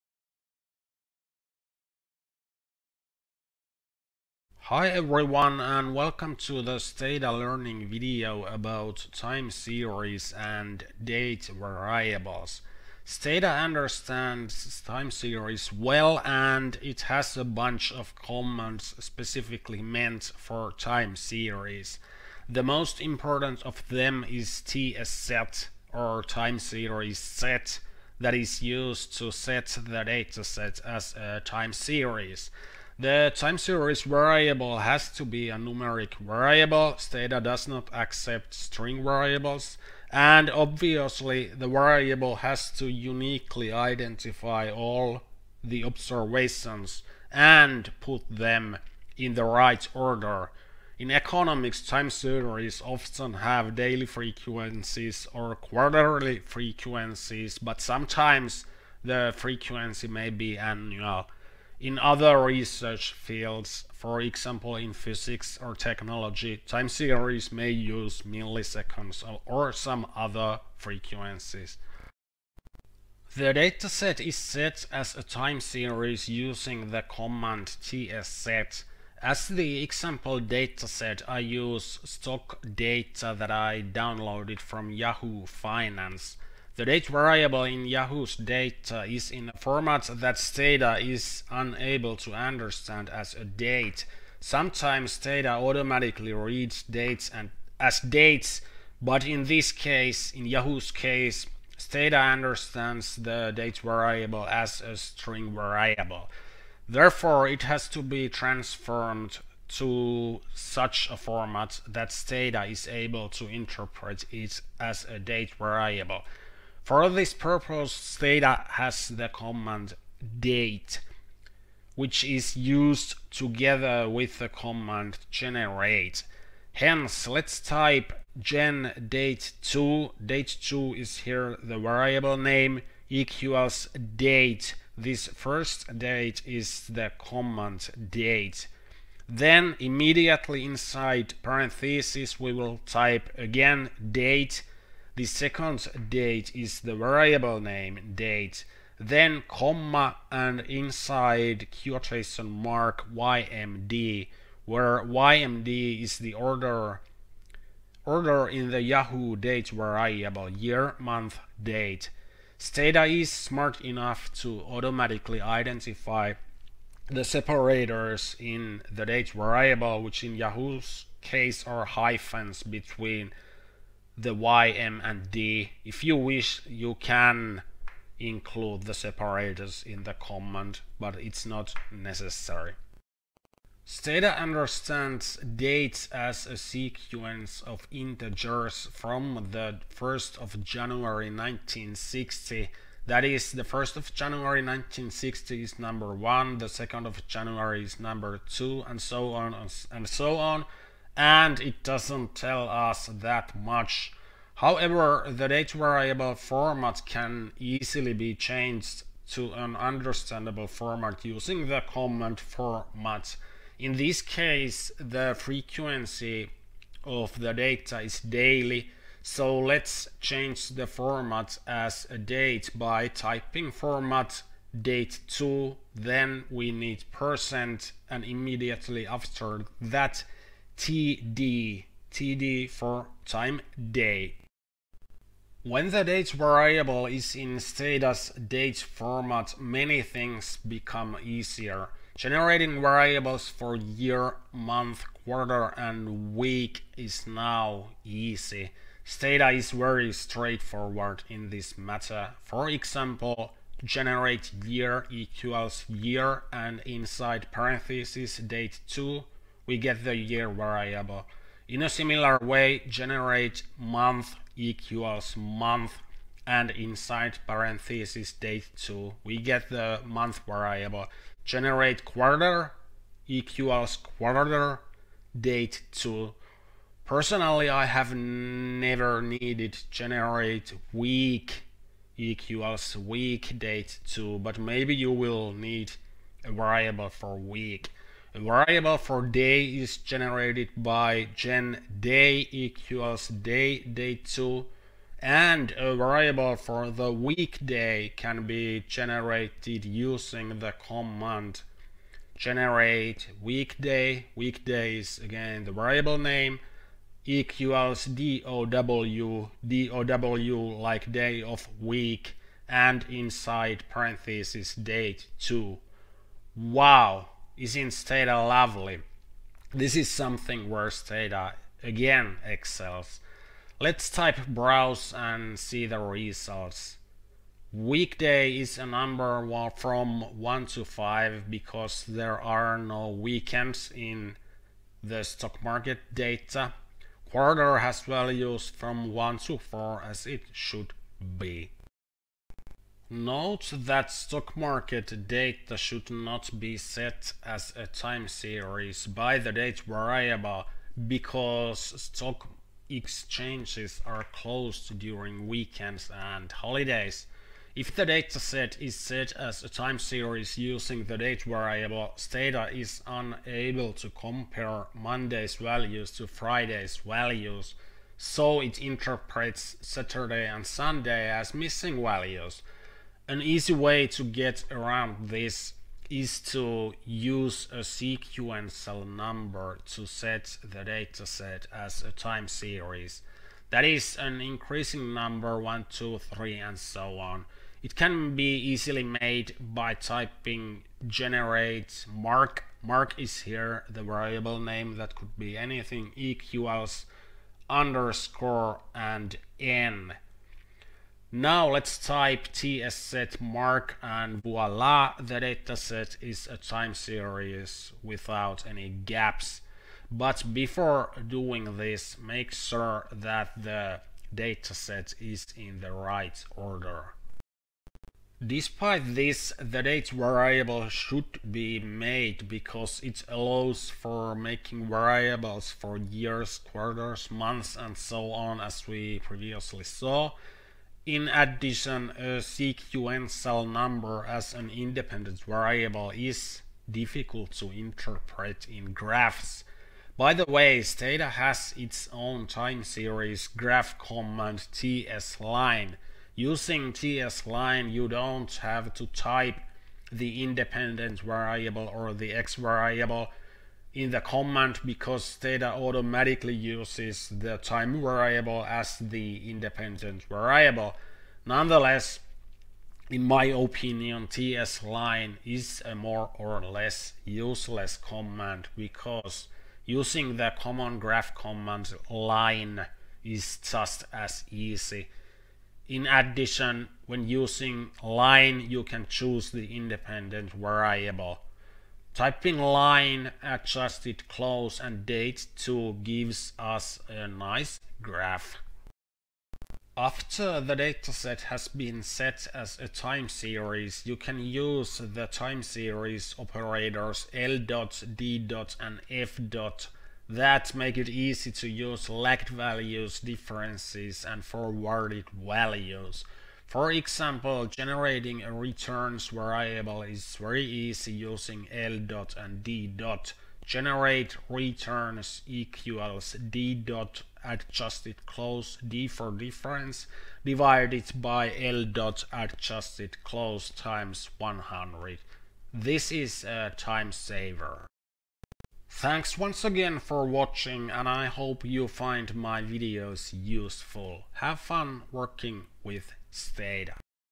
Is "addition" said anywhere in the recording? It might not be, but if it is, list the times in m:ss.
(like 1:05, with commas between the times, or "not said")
7:11, 7:56.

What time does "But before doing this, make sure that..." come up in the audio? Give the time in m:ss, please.
6:50.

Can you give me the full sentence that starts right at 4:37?
Personally, I have never needed generate week equals week date 2, but maybe you will need a variable for week.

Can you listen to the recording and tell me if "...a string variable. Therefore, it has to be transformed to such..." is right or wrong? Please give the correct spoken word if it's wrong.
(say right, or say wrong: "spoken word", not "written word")
right.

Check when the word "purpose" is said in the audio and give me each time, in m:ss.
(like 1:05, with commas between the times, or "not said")
1:57.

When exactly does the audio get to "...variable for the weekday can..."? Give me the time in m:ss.
4:55.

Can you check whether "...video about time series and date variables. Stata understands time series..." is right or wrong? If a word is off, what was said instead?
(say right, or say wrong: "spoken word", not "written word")
right.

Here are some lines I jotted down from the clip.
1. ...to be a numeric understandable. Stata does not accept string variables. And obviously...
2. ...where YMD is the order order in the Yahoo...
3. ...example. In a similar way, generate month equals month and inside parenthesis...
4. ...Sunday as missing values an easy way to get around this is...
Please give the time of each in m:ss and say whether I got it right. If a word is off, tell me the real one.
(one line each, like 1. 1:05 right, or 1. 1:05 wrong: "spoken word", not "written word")
1. 0:35 wrong: "variable", not "understandable"
2. 2:34 right
3. 4:20 wrong: "variable", not "example"
4. 6:10 right.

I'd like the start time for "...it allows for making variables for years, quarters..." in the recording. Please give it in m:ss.
7:03.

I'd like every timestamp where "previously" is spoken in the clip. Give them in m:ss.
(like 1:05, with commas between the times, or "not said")
7:09.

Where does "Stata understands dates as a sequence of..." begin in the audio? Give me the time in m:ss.
3:03.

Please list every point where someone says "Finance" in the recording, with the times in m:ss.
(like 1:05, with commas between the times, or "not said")
1:25.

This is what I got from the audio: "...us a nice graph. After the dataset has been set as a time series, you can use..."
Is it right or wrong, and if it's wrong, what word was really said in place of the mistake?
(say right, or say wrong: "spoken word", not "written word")
right.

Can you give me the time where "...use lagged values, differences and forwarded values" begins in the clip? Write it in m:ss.
8:21.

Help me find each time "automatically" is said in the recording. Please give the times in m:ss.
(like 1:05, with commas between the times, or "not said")
1:35, 2:44, 7:35.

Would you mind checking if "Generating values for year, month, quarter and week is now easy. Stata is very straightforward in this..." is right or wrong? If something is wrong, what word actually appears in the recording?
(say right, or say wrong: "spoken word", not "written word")
wrong: "variables", not "values".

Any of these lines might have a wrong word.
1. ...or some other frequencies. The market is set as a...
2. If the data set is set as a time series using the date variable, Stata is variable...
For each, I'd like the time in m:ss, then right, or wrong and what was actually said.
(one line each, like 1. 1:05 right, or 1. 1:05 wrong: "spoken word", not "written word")
1. 1:09 wrong: "dataset", not "market"
2. 5:57 wrong: "unable", not "variable".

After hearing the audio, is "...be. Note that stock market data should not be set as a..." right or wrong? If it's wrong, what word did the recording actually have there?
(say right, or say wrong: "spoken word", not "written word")
right.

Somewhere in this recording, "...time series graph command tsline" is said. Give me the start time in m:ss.
7:22.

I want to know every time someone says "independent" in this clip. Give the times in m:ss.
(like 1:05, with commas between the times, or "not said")
7:14, 7:30, 7:39, 7:59.